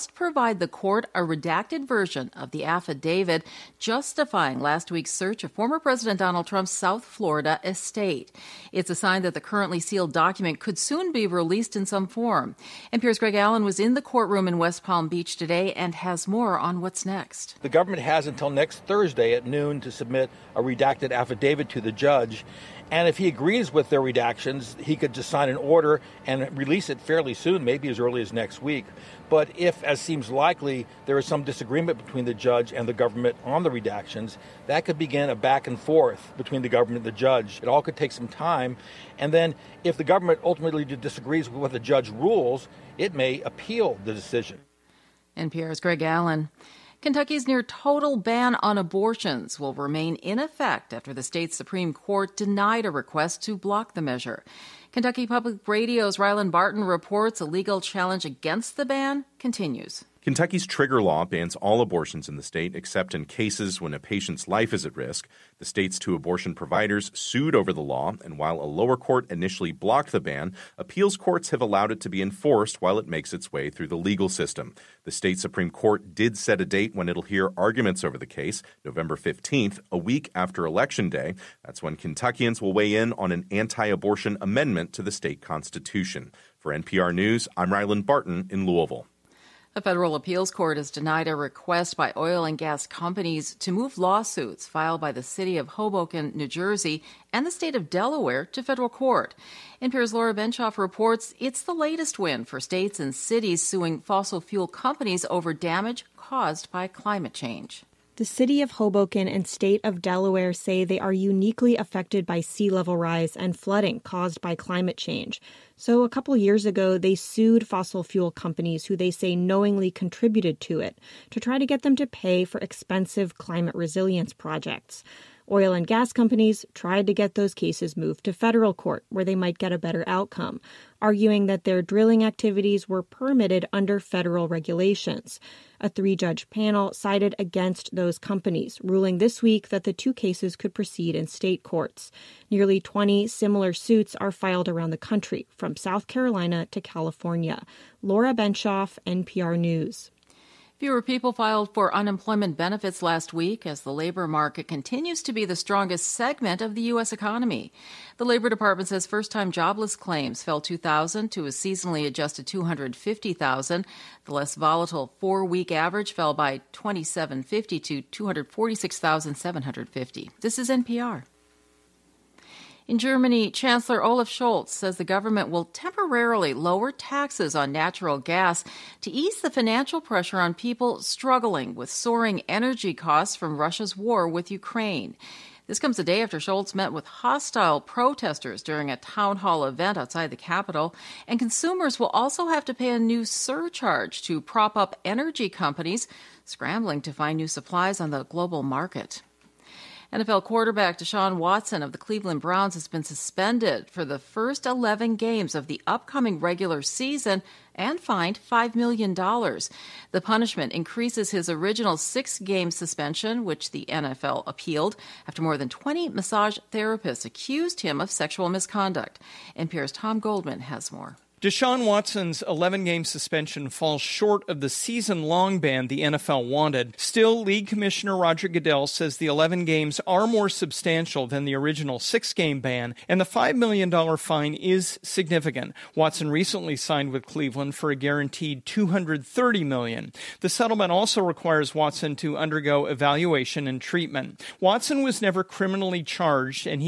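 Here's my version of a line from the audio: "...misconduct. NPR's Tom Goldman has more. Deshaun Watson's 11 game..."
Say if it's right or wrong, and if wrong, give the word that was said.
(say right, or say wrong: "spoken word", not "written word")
right.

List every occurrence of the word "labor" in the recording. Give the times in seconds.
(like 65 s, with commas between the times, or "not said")
153 s, 158 s.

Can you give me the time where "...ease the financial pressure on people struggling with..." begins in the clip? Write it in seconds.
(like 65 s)
179 s.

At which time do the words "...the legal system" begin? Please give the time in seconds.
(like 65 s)
73 s.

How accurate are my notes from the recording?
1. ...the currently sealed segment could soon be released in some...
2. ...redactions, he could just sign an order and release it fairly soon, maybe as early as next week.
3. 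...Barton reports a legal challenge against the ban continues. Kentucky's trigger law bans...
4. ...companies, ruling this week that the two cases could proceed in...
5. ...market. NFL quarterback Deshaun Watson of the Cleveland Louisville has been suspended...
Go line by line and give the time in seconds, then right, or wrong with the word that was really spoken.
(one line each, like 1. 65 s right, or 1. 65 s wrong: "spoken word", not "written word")
1. 9 s wrong: "document", not "segment"
2. 24 s right
3. 56 s right
4. 138 s right
5. 198 s wrong: "Browns", not "Louisville".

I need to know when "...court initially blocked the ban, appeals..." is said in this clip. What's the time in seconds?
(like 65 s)
68 s.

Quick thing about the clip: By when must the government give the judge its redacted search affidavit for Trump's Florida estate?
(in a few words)
Next Thursday at noon.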